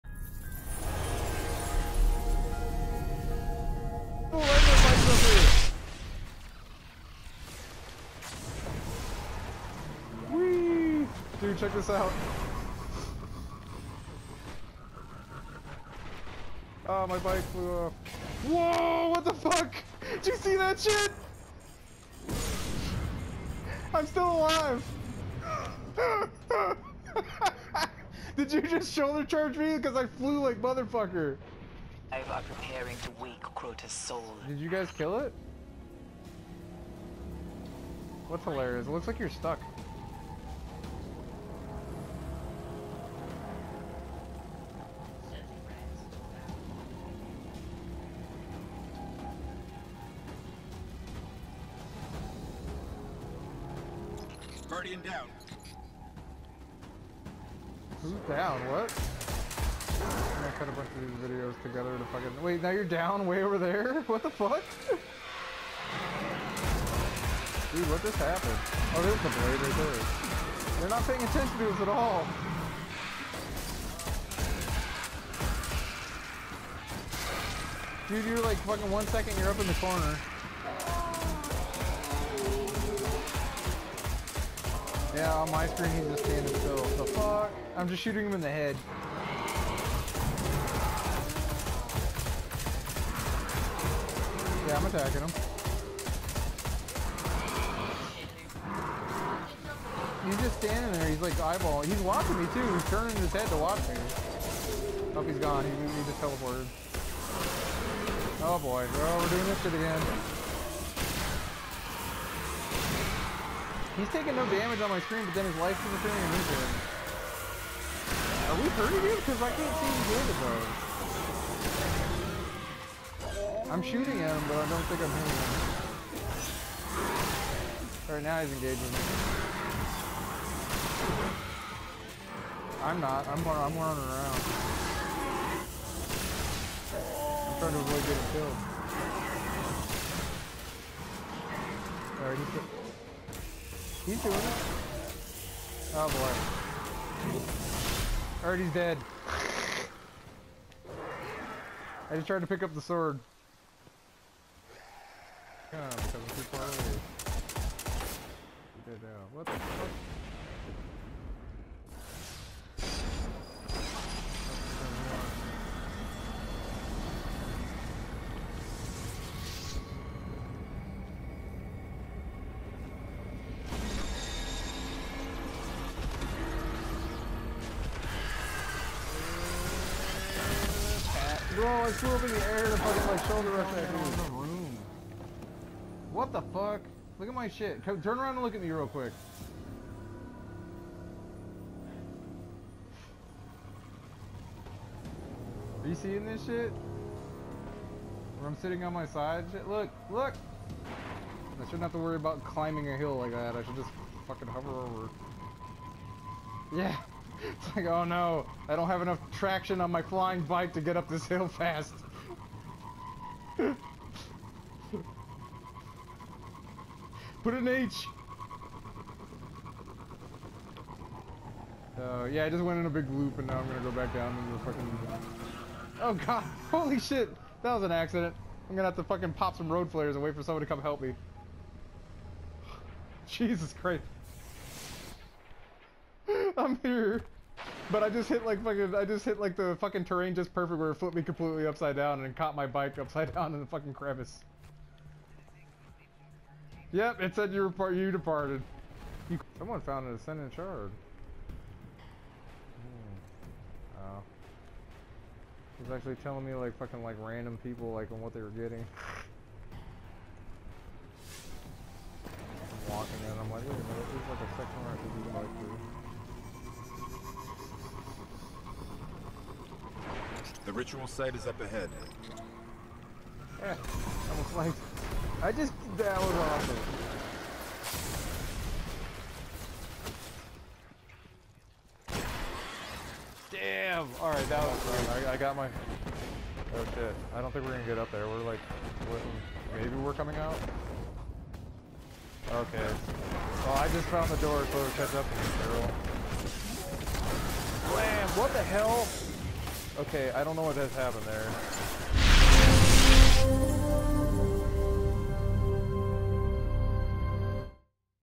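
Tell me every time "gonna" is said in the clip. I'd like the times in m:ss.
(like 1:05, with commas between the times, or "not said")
3:43, 3:48, 4:47.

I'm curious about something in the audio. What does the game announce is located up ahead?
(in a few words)
The ritual site.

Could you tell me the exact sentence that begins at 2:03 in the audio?
I'm shooting him, but I don't think I'm hitting him.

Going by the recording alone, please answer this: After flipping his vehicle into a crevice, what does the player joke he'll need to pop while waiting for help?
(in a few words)
Road flares.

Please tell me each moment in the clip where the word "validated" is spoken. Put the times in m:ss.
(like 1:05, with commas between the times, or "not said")
not said.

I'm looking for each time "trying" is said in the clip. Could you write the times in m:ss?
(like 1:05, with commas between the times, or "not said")
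2:17.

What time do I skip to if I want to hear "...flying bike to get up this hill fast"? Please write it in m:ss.
3:30.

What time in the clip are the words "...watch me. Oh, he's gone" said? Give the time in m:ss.
1:43.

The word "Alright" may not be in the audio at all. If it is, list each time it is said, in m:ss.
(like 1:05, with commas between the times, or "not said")
2:08, 2:22, 2:28, 4:44.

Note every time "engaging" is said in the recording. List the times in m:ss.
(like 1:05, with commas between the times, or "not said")
2:08.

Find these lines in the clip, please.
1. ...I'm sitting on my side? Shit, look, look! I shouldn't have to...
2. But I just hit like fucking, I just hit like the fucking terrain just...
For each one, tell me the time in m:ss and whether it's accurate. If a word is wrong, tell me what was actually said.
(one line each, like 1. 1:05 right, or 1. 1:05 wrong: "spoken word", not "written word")
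1. 3:18 right
2. 3:57 right.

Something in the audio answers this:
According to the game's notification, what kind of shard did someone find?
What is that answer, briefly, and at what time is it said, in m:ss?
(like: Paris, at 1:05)
Ascendant shard, at 4:10.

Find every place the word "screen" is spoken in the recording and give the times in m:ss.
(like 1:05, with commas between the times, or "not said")
1:25, 1:55.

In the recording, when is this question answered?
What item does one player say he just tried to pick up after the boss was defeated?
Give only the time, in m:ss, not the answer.
2:32.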